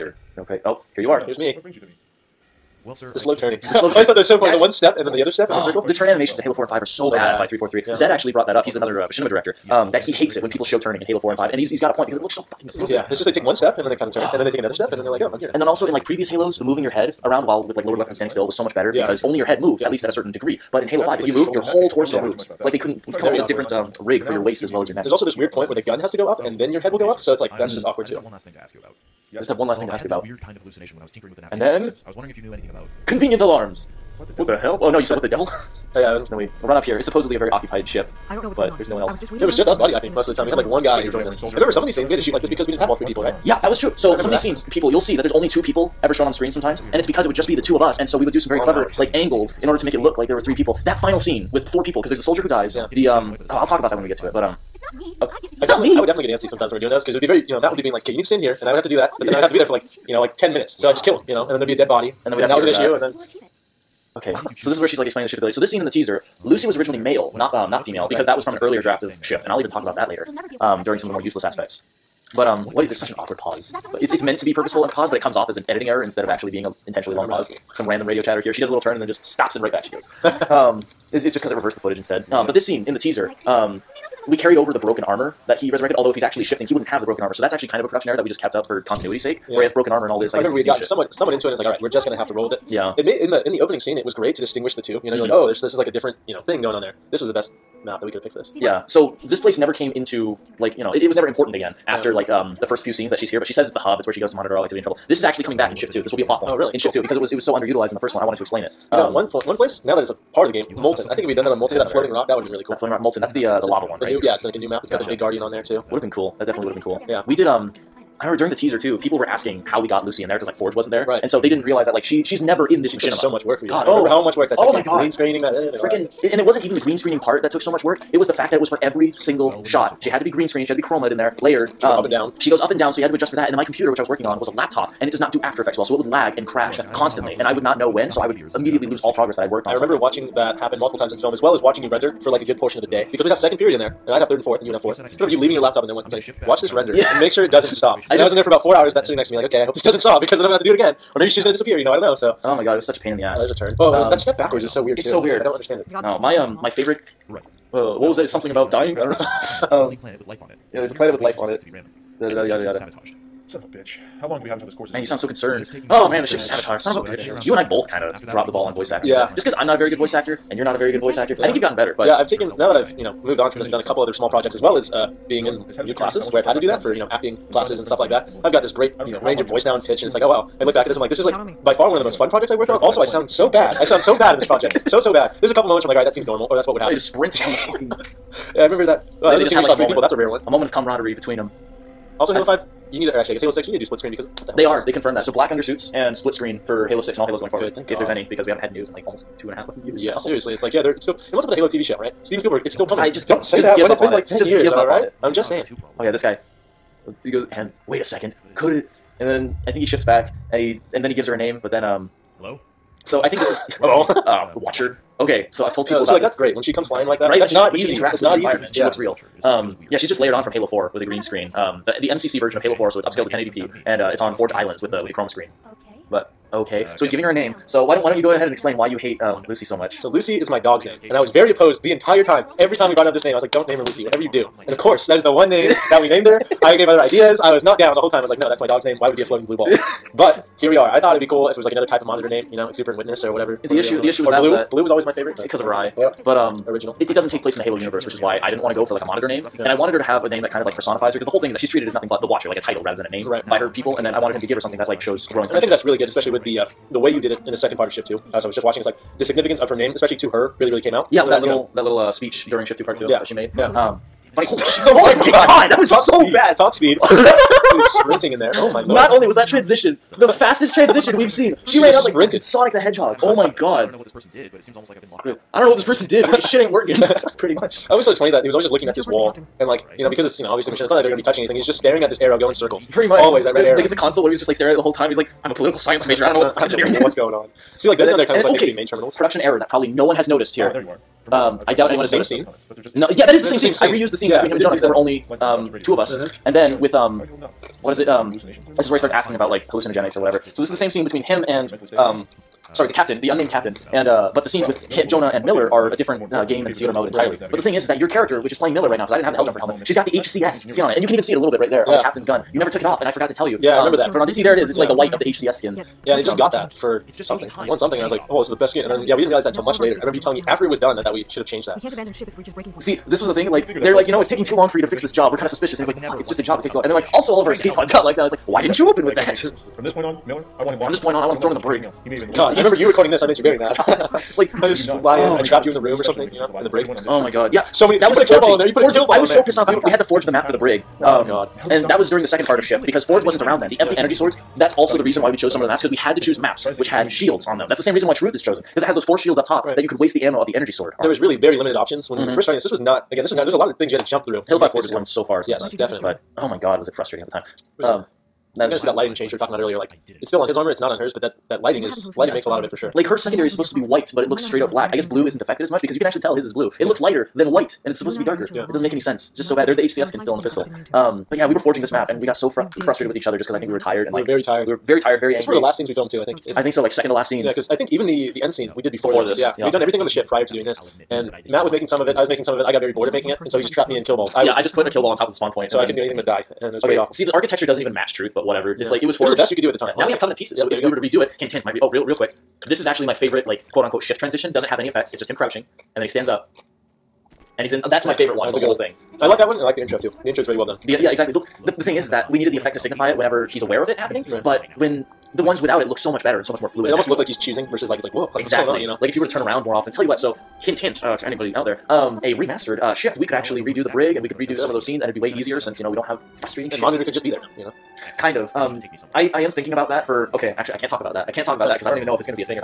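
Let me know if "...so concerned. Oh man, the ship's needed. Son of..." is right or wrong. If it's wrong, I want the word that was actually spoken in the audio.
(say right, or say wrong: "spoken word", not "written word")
wrong: "sabotaged", not "needed".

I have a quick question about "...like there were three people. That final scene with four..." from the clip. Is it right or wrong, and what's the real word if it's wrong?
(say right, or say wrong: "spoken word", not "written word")
right.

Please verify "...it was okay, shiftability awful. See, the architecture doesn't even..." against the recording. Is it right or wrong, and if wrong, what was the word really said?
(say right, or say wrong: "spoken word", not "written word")
wrong: "pretty", not "shiftability".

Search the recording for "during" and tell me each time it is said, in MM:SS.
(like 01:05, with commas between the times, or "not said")
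01:10, 01:58, 04:22, 05:42.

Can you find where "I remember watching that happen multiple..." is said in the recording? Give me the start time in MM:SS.
02:19.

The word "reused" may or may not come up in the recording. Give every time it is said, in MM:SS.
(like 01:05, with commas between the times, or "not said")
04:53.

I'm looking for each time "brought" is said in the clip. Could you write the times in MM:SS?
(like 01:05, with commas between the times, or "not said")
00:08, 03:52.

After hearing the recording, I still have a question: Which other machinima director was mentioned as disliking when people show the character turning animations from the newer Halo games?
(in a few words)
Zed.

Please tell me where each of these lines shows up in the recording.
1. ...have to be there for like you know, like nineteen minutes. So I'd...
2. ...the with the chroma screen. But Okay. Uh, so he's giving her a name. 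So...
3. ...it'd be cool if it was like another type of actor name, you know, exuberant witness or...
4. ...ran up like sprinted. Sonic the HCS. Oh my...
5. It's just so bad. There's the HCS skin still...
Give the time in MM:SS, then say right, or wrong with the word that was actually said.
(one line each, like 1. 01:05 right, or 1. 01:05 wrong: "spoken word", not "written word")
1. 00:59 wrong: "ten", not "nineteen"
2. 03:44 right
3. 04:01 wrong: "monitor", not "actor"
4. 04:31 wrong: "Hedgehog", not "HCS"
5. 06:09 right.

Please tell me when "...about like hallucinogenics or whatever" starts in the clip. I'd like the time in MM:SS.
04:59.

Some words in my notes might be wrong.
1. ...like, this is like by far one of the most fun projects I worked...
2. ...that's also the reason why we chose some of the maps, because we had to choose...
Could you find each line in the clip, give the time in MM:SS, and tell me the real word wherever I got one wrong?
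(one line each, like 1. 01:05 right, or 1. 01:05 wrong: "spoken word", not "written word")
1. 03:00 right
2. 05:44 right.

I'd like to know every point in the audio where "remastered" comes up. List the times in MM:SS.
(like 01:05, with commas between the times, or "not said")
06:52.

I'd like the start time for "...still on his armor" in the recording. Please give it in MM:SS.
06:00.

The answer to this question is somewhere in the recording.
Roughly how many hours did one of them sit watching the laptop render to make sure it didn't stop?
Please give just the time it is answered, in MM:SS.
02:28.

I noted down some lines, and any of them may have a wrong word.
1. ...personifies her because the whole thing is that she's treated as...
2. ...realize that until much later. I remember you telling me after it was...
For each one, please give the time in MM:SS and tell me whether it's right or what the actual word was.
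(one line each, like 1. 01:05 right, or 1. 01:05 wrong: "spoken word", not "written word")
1. 04:10 right
2. 05:19 right.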